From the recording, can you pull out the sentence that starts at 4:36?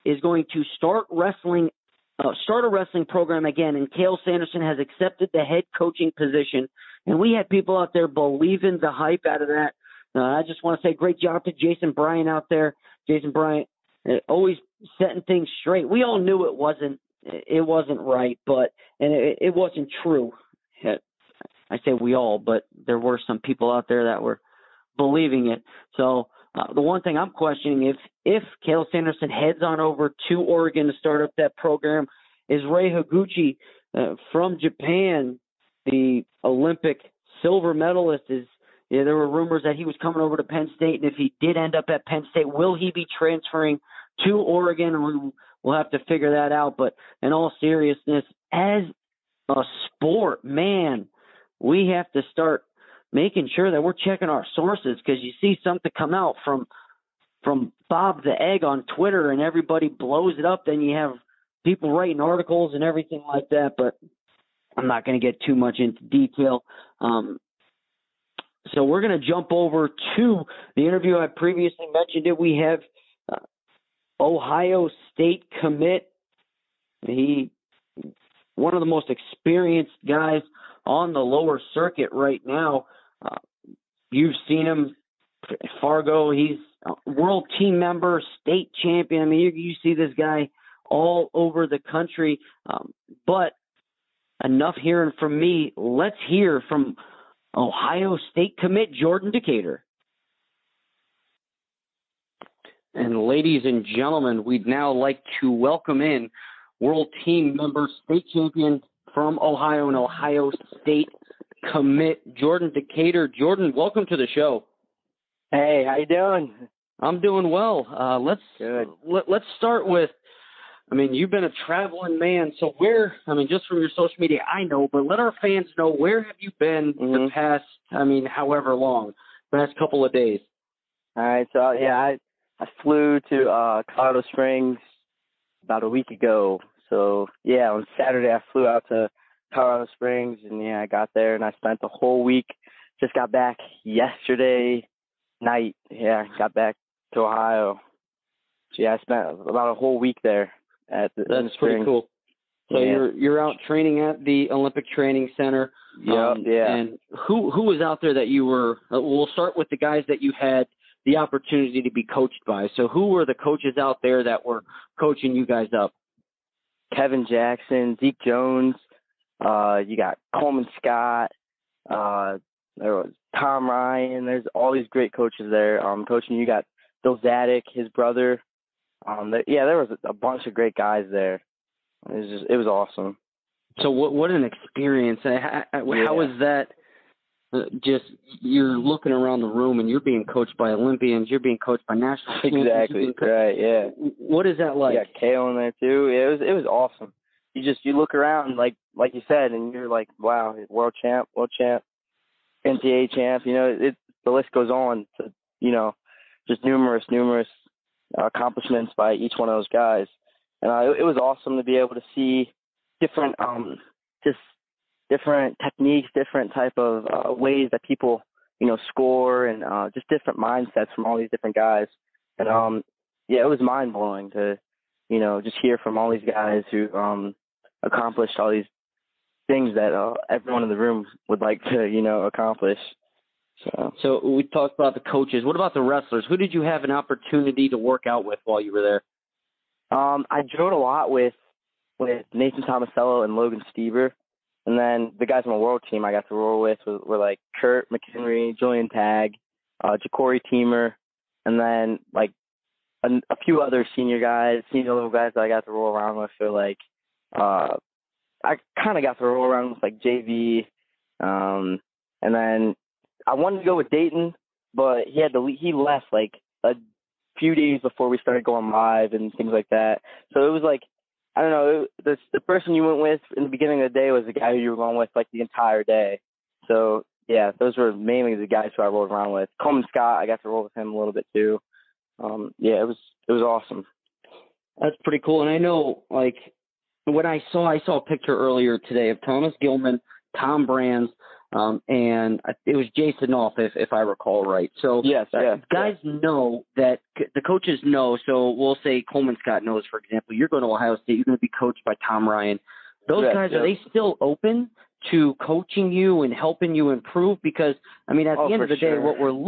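So yeah, those were mainly the guys who I rolled around with.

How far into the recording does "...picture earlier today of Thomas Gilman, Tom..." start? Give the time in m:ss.
4:48.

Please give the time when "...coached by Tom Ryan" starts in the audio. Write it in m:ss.
5:01.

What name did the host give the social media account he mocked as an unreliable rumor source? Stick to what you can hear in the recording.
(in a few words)
Bob the Egg.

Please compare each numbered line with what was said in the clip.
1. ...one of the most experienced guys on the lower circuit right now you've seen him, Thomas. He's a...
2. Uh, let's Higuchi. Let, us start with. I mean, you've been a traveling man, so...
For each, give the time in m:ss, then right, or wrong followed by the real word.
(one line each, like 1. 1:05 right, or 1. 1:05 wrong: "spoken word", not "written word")
1. 1:18 wrong: "Fargo", not "Thomas"
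2. 1:57 wrong: "Good", not "Higuchi".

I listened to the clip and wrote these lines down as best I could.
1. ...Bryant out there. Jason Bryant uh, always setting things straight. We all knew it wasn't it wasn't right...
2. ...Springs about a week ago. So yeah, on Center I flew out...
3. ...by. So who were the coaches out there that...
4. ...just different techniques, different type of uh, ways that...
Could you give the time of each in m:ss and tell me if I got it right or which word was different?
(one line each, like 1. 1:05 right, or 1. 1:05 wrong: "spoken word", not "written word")
1. 0:11 right
2. 2:14 wrong: "Saturday", not "Center"
3. 2:42 right
4. 3:34 right.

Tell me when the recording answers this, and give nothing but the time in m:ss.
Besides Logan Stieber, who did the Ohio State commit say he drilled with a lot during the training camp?
4:02.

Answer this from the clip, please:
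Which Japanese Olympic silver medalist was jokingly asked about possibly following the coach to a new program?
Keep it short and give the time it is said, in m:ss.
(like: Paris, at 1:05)
Rei Higuchi, at 0:32.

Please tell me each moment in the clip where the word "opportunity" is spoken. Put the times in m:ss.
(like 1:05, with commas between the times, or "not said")
2:41, 3:56.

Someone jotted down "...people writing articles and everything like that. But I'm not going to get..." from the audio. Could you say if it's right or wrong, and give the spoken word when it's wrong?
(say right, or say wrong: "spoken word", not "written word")
right.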